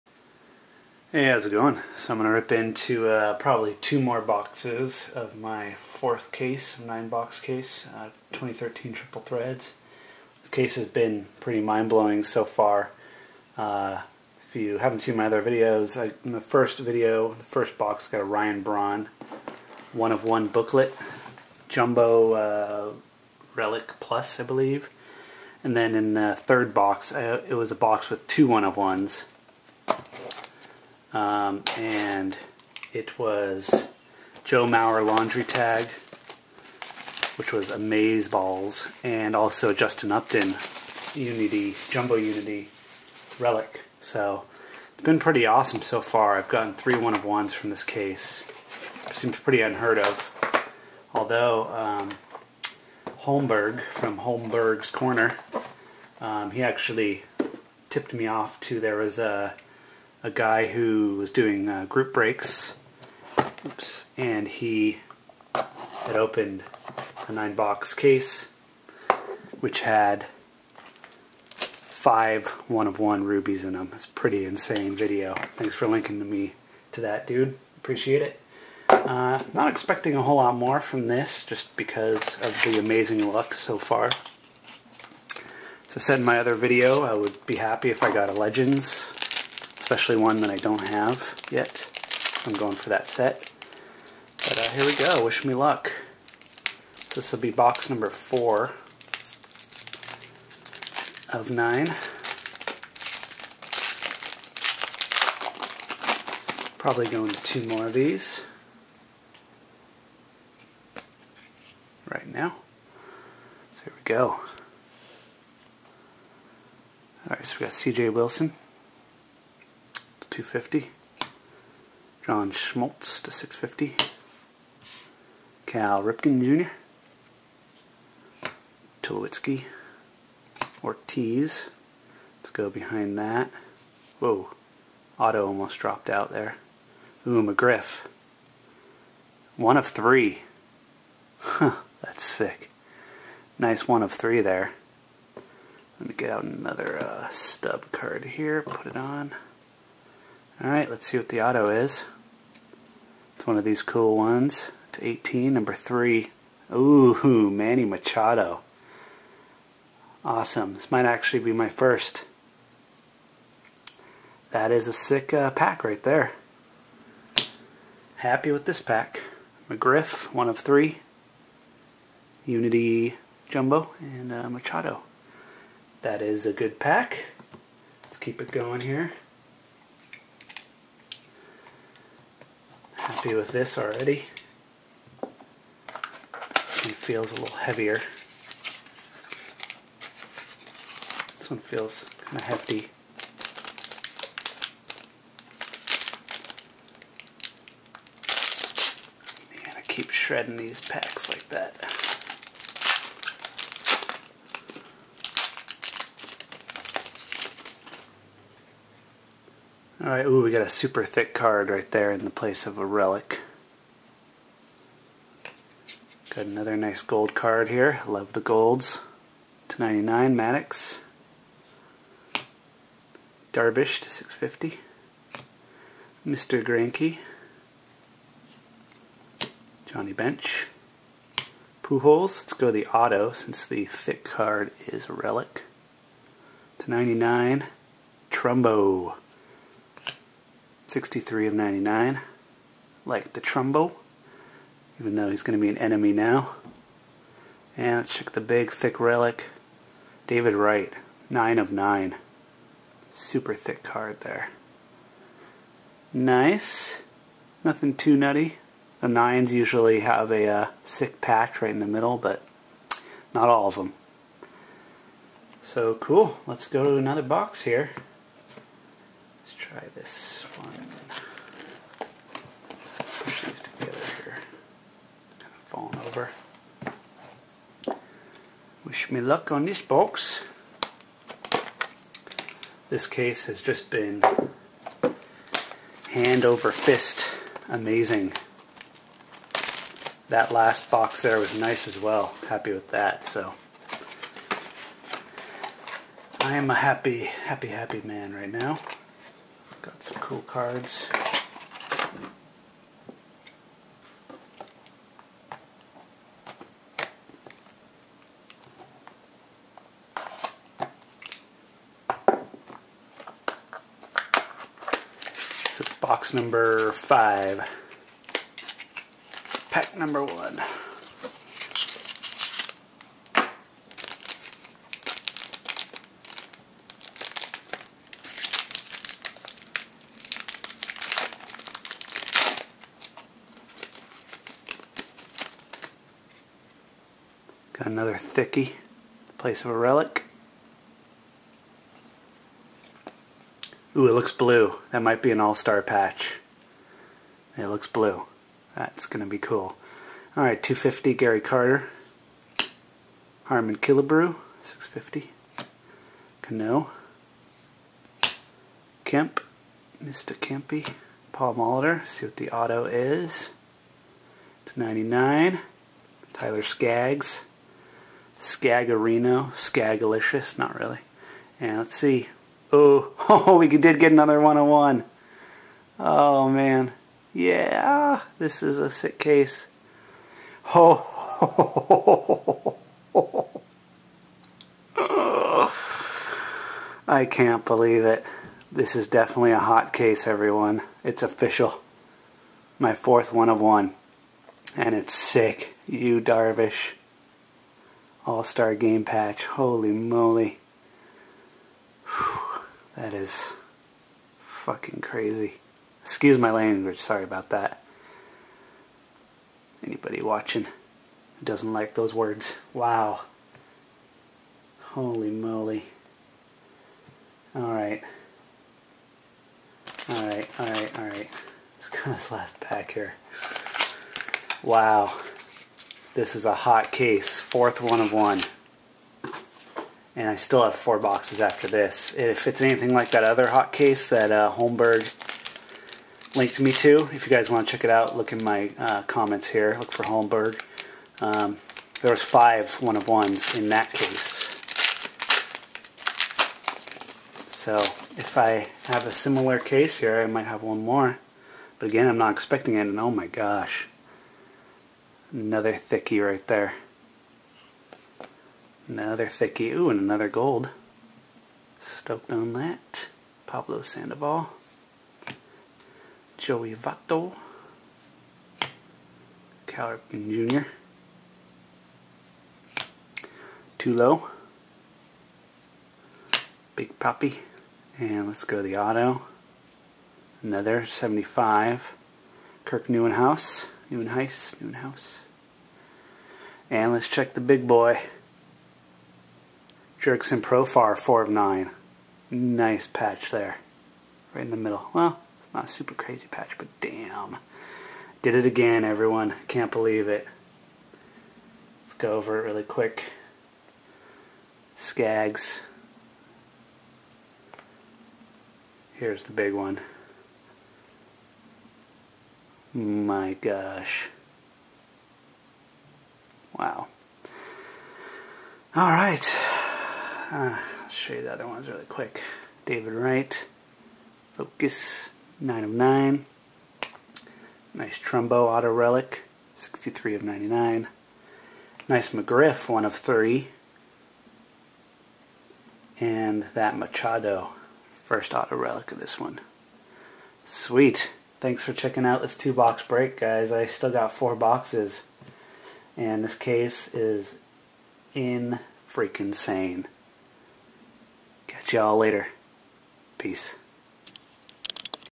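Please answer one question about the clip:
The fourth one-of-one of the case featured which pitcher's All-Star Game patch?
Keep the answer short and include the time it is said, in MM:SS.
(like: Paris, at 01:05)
Yu Darvish, at 06:35.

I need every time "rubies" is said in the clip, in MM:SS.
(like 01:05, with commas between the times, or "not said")
01:13.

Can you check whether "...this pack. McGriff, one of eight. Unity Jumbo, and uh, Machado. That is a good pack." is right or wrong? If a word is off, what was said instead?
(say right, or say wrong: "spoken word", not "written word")
wrong: "three", not "eight".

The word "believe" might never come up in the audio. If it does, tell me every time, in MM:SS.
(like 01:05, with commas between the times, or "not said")
00:24, 06:27, 08:19.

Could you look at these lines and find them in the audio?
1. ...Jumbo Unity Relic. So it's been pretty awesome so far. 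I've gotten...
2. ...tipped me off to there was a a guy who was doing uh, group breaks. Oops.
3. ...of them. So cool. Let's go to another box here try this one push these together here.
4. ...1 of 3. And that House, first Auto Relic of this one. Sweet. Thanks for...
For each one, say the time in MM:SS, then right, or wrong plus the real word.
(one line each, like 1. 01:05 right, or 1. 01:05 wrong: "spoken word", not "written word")
1. 00:41 right
2. 00:57 right
3. 04:23 right
4. 08:52 wrong: "Machado", not "House".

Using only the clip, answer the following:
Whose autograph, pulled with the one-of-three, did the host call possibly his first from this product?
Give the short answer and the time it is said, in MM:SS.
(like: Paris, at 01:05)
Manny Machado, at 02:37.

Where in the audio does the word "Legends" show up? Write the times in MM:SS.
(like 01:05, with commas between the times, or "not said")
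01:28.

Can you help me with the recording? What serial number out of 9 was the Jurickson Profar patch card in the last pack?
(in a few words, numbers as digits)
4.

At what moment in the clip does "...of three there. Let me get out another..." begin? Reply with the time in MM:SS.
02:24.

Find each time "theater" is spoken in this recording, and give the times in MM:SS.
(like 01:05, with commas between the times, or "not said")
not said.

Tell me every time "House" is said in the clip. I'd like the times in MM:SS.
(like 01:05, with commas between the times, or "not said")
08:04.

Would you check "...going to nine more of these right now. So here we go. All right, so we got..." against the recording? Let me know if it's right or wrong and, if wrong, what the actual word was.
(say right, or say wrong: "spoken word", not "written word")
wrong: "two", not "nine".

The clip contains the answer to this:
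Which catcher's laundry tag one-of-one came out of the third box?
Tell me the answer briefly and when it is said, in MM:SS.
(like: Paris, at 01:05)
Joe Mauer, at 00:34.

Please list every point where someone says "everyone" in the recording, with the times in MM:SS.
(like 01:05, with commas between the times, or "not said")
06:30, 08:18.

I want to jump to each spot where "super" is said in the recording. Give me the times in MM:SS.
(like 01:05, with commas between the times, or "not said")
03:30, 04:13, 08:15.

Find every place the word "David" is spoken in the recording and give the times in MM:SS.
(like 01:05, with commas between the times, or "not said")
04:10, 08:42.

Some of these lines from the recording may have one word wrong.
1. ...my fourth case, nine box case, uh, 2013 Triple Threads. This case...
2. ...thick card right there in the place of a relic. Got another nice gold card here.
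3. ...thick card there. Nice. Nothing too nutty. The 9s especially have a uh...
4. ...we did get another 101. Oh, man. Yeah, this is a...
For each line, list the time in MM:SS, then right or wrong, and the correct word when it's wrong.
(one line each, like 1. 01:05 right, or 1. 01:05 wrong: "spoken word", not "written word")
1. 00:05 right
2. 03:31 right
3. 04:13 wrong: "usually", not "especially"
4. 06:13 right.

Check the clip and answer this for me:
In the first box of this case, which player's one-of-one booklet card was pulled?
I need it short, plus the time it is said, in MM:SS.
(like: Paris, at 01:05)
Ryan Braun, at 00:18.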